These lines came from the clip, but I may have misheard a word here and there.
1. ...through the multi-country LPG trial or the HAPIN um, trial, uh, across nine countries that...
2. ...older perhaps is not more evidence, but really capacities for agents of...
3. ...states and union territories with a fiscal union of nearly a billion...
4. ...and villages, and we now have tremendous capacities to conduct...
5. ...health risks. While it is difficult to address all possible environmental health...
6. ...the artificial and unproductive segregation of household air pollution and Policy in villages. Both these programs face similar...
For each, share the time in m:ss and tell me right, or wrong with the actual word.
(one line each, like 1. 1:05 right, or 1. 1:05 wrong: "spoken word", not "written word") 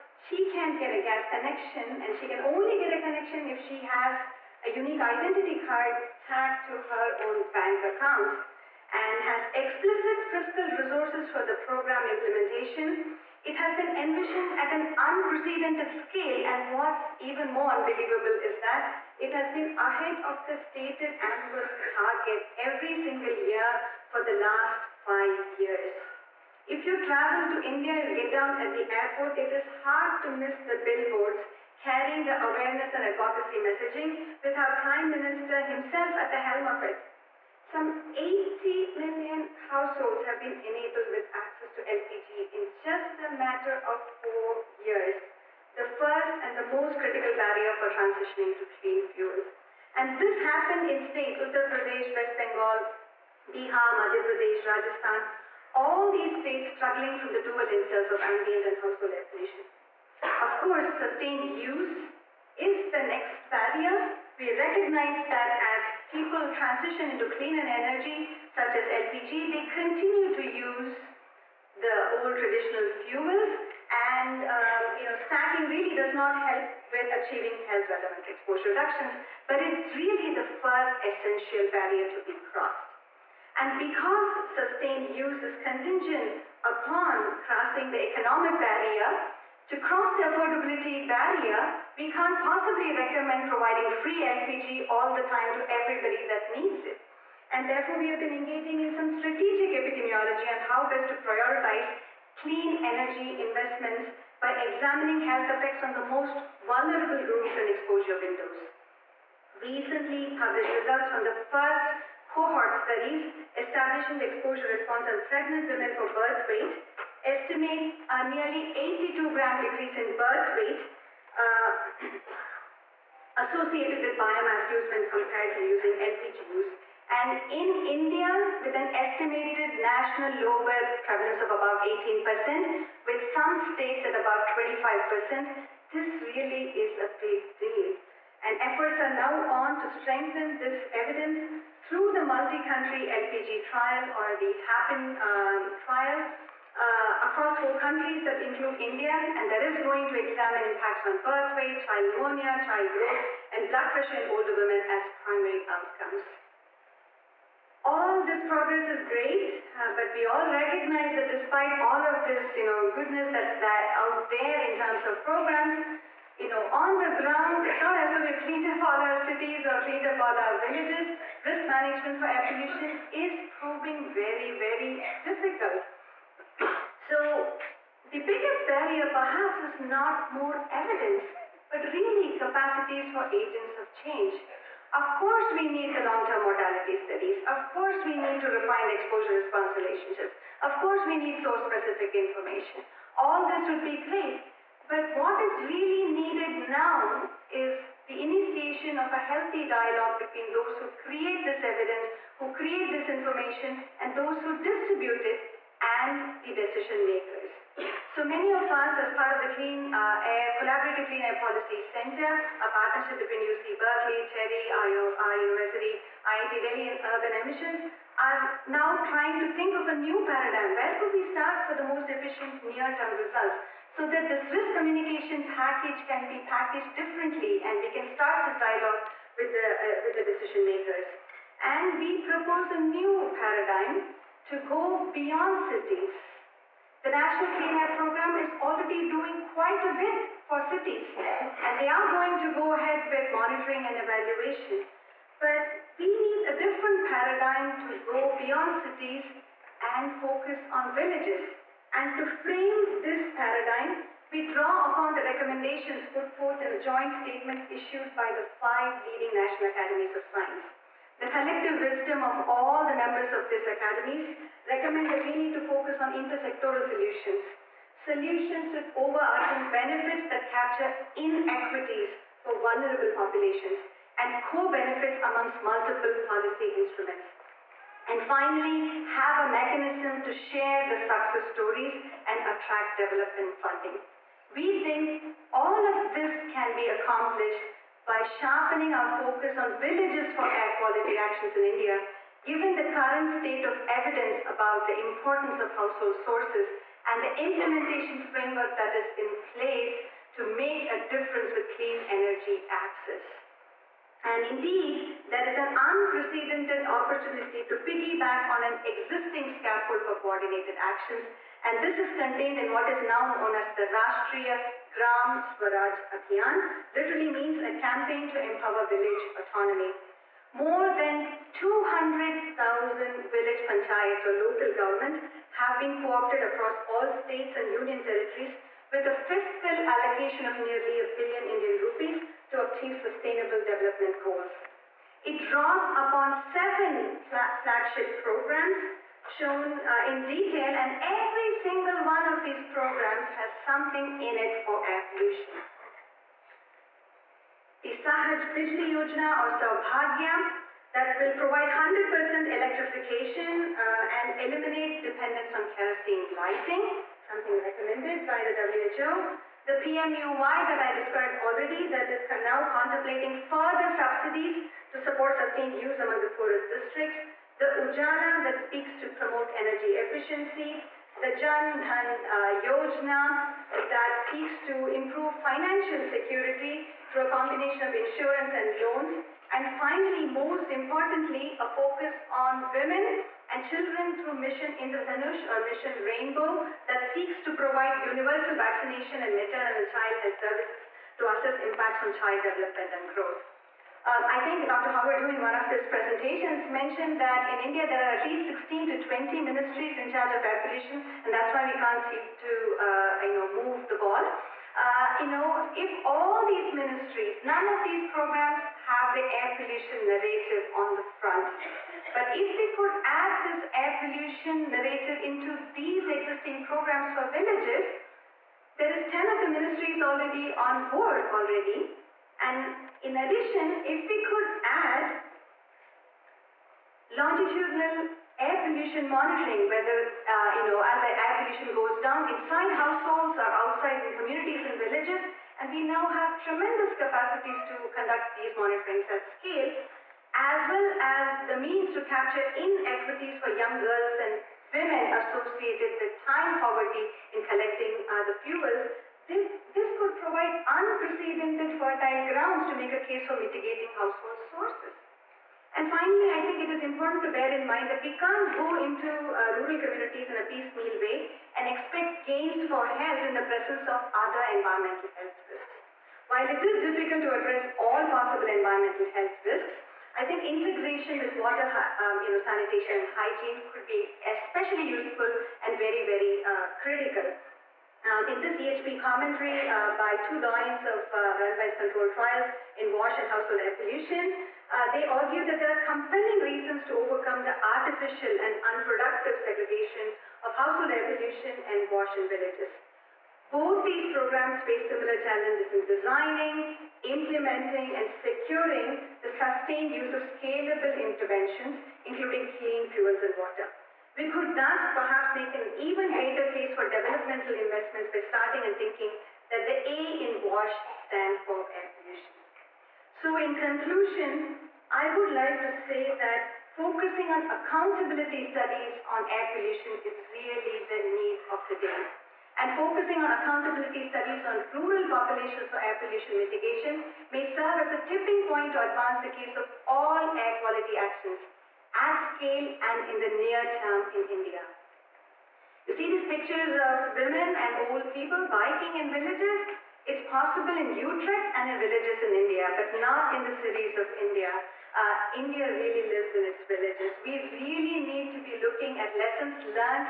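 1. 2:21 wrong: "four", not "nine"
2. 2:58 wrong: "barrier", not "older"
3. 5:27 wrong: "allocation", not "union"
4. 7:14 right
5. 7:45 right
6. 8:07 wrong: "WASH", not "Policy".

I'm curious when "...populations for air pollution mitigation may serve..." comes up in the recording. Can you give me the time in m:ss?
8:45.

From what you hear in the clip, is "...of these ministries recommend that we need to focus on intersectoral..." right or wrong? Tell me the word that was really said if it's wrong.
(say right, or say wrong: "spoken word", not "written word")
wrong: "academies", not "ministries".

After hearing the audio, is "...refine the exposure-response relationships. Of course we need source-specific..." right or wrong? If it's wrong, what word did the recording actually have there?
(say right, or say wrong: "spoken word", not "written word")
right.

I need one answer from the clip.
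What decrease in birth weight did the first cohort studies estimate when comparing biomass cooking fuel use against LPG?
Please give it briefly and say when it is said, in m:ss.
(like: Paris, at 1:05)
82 grams, at 1:58.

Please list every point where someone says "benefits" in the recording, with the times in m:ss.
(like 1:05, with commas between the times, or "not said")
4:29, 4:34.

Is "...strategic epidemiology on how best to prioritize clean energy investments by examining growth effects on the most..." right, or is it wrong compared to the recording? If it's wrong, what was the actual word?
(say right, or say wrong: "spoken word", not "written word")
wrong: "health", not "growth".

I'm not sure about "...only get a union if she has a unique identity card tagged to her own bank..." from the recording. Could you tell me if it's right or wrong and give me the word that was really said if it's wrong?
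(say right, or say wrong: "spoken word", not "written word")
wrong: "connection", not "union".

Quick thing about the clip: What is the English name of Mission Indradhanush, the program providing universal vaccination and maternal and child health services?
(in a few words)
Mission Rainbow.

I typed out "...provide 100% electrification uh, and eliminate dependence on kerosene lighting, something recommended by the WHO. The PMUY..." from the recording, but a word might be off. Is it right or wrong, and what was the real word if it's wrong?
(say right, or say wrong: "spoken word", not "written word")
right.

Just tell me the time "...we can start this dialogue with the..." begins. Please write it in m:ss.
3:47.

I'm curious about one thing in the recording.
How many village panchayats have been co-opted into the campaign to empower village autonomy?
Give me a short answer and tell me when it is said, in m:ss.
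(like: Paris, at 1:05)
200,000, at 5:21.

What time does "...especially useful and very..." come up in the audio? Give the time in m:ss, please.
7:54.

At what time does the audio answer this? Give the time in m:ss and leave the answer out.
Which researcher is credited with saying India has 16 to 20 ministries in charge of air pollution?
6:34.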